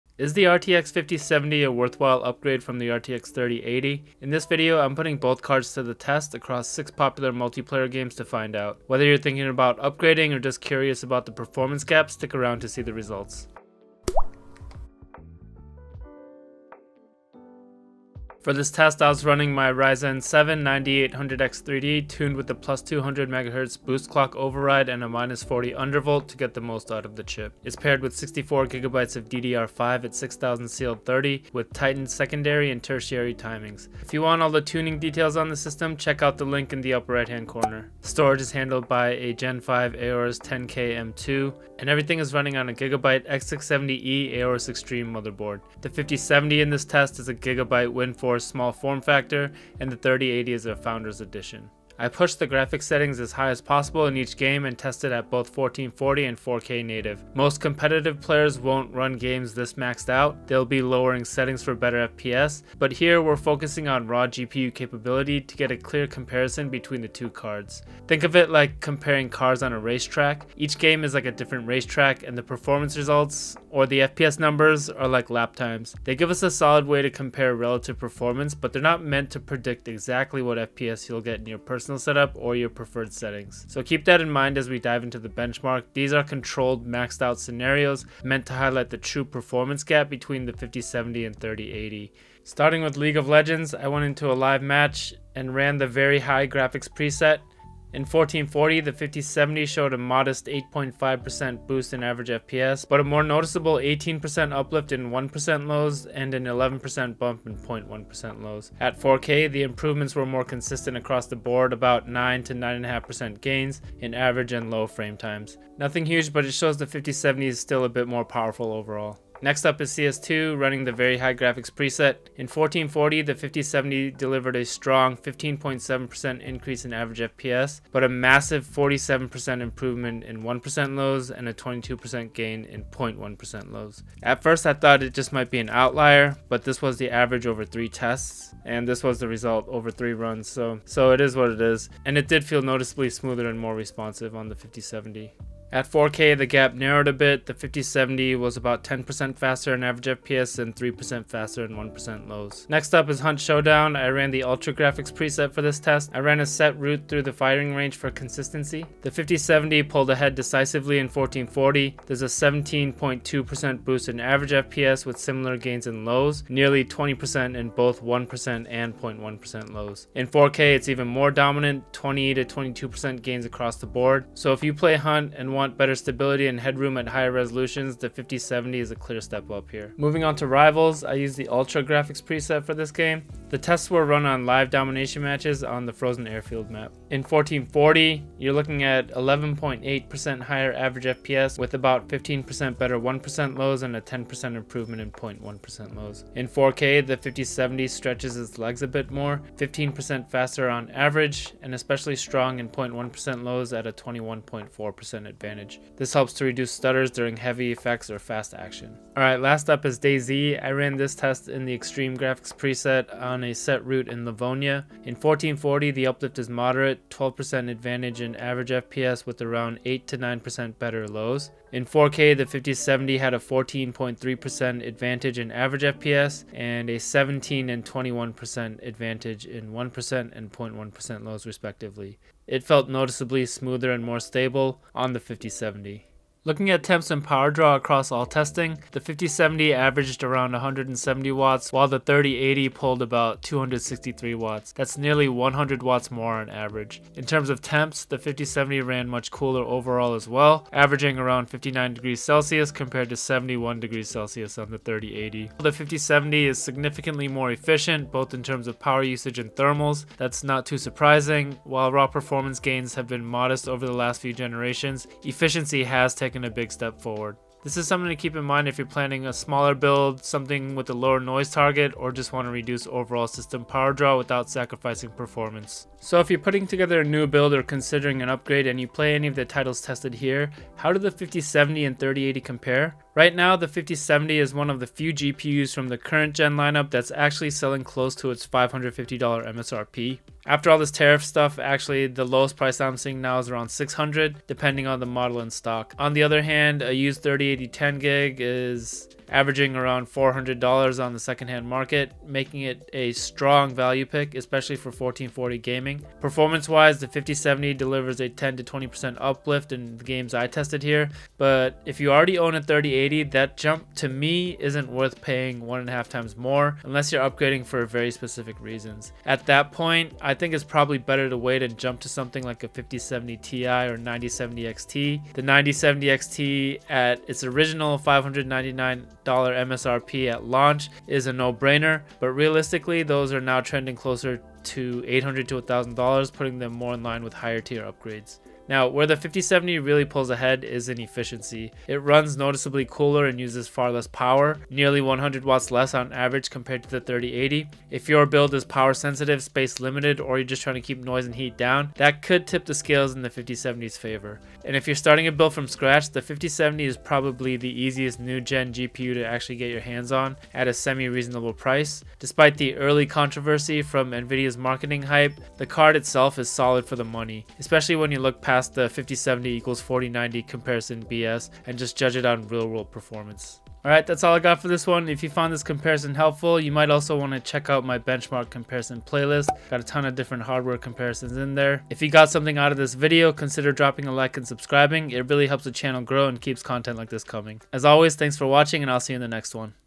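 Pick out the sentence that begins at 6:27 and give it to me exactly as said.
As always, thanks for watching and I'll see you in the next one.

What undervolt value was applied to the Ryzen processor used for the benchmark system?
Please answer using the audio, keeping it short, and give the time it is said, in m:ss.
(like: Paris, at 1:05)
-40, at 0:25.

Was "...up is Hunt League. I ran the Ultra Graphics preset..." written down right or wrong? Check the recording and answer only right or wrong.
wrong.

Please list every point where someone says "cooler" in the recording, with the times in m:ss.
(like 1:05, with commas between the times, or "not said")
4:09, 5:42.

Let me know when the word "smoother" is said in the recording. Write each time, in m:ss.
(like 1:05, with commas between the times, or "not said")
2:23, 3:53.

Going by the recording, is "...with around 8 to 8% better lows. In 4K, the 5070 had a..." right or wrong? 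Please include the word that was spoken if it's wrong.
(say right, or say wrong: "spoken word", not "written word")
wrong: "9", not "8".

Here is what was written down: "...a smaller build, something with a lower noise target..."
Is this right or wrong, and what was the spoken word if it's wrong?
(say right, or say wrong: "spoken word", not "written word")
right.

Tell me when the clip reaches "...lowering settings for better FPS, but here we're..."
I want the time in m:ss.
1:00.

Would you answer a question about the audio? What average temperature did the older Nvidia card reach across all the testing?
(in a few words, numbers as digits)
71 degrees Celsius.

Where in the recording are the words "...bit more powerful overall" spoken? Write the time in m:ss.
1:57.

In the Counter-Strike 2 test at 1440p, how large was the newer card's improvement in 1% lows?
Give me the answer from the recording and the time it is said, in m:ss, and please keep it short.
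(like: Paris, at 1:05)
47%, at 2:08.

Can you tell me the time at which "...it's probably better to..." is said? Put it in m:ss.
5:20.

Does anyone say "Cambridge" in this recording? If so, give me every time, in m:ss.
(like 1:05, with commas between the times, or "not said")
not said.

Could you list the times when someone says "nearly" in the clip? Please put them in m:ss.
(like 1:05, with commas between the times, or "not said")
2:46, 4:04, 5:44.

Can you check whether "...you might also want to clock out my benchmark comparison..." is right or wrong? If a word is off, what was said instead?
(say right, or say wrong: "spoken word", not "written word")
wrong: "check", not "clock".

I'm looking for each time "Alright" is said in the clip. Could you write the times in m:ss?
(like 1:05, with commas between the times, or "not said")
3:29, 6:13.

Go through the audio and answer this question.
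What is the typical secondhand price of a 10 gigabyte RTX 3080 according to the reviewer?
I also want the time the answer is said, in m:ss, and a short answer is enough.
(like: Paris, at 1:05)
$400, at 5:00.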